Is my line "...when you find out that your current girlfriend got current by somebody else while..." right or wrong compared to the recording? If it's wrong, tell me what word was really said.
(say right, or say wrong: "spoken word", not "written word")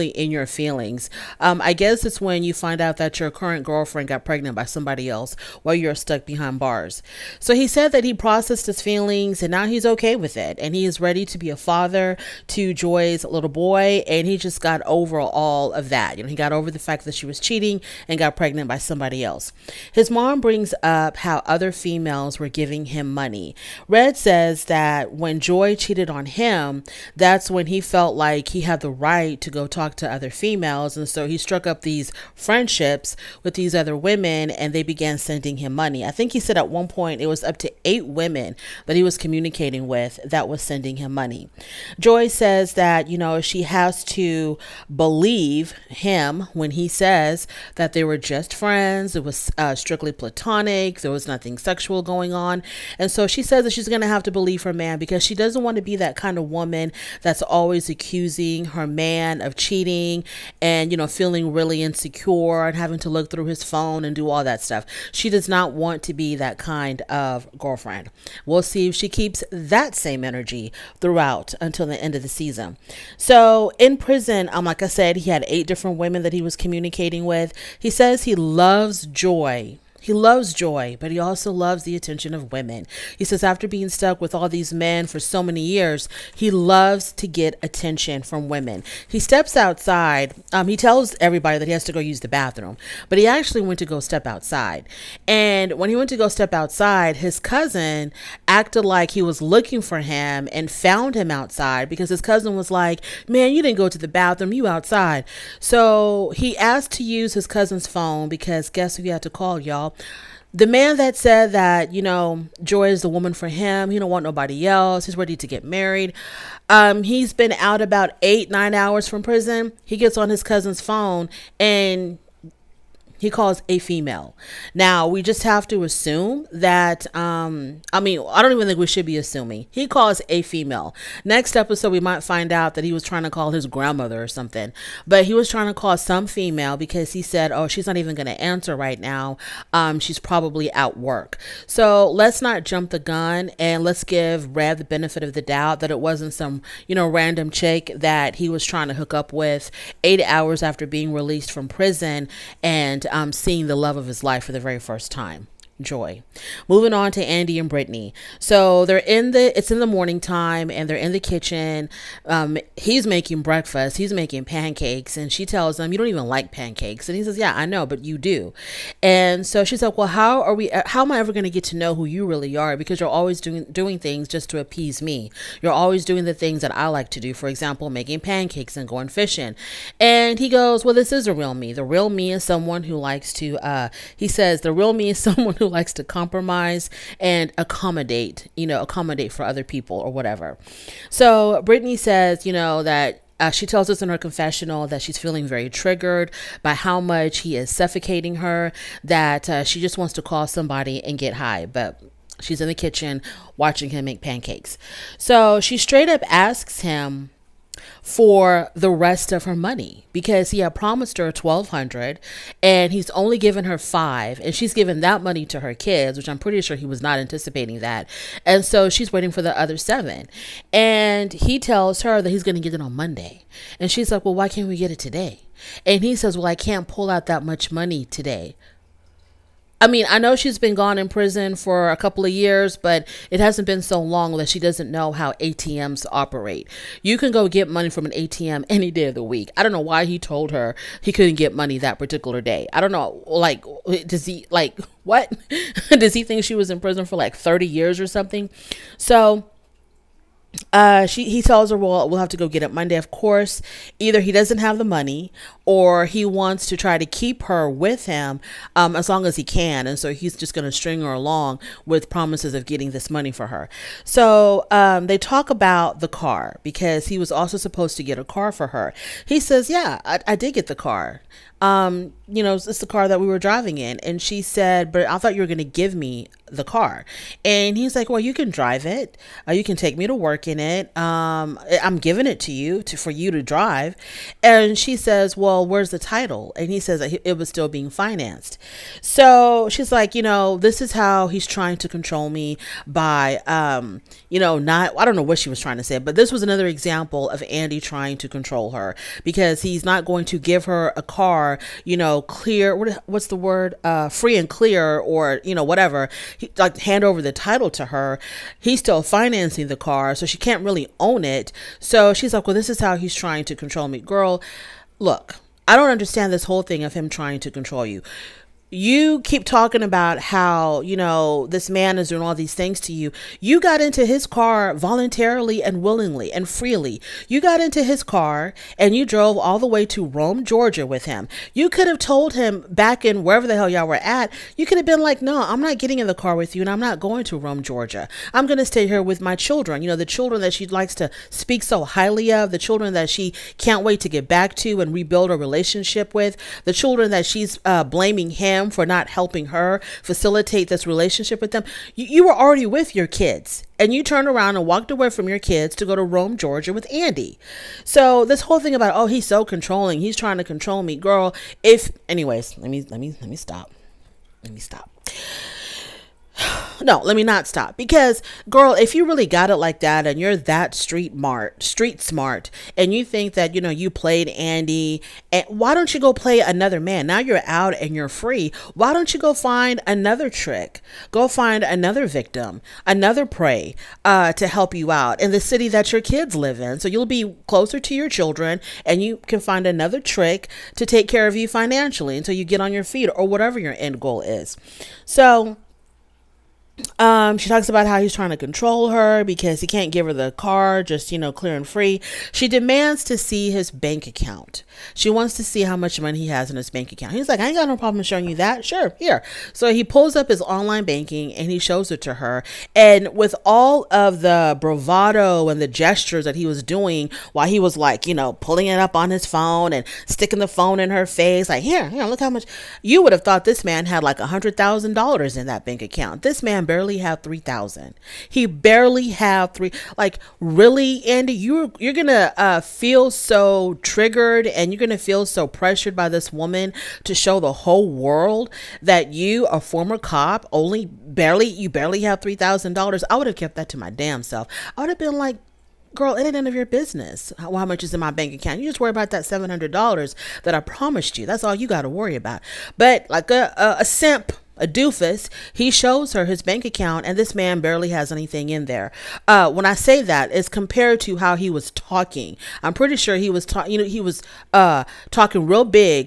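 wrong: "pregnant", not "current".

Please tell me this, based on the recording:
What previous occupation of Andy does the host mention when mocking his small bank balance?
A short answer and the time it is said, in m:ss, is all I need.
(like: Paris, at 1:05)
Cop, at 7:19.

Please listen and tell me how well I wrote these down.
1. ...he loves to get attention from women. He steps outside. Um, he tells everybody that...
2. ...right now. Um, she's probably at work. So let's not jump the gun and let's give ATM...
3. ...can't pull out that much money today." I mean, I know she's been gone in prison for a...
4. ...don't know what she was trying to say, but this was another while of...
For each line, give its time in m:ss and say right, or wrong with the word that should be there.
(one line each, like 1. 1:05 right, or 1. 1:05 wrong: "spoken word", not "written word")
1. 1:26 right
2. 2:18 wrong: "Redd", not "ATM"
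3. 3:46 right
4. 4:55 wrong: "example", not "while".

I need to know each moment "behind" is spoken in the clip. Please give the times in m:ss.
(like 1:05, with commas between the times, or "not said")
0:06.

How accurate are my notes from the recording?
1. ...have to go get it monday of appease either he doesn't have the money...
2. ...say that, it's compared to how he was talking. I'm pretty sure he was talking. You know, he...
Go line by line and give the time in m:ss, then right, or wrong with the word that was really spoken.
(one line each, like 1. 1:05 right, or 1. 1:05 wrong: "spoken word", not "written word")
1. 4:12 wrong: "course", not "appease"
2. 7:39 right.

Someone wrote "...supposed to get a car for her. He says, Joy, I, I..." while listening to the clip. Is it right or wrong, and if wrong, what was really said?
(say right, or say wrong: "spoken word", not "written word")
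wrong: "Yeah", not "Joy".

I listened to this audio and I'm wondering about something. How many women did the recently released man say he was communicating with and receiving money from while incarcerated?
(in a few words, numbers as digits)
8.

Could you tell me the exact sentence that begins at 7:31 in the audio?
That's all you got to worry about.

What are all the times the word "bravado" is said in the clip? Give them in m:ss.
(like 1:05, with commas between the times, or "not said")
6:54.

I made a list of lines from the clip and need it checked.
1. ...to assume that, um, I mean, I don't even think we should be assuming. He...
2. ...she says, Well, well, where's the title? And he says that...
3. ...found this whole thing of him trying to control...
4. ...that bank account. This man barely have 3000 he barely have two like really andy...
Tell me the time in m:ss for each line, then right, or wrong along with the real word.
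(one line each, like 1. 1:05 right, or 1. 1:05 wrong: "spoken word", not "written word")
1. 2:05 right
2. 4:44 right
3. 5:15 wrong: "understand", not "found"
4. 7:05 wrong: "three", not "two".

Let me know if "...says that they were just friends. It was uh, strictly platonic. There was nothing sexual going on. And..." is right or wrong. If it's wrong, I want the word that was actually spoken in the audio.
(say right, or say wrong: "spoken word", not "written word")
right.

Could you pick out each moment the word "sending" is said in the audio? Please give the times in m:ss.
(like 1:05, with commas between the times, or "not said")
0:35, 0:40.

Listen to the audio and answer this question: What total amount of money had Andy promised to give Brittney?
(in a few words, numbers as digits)
1200.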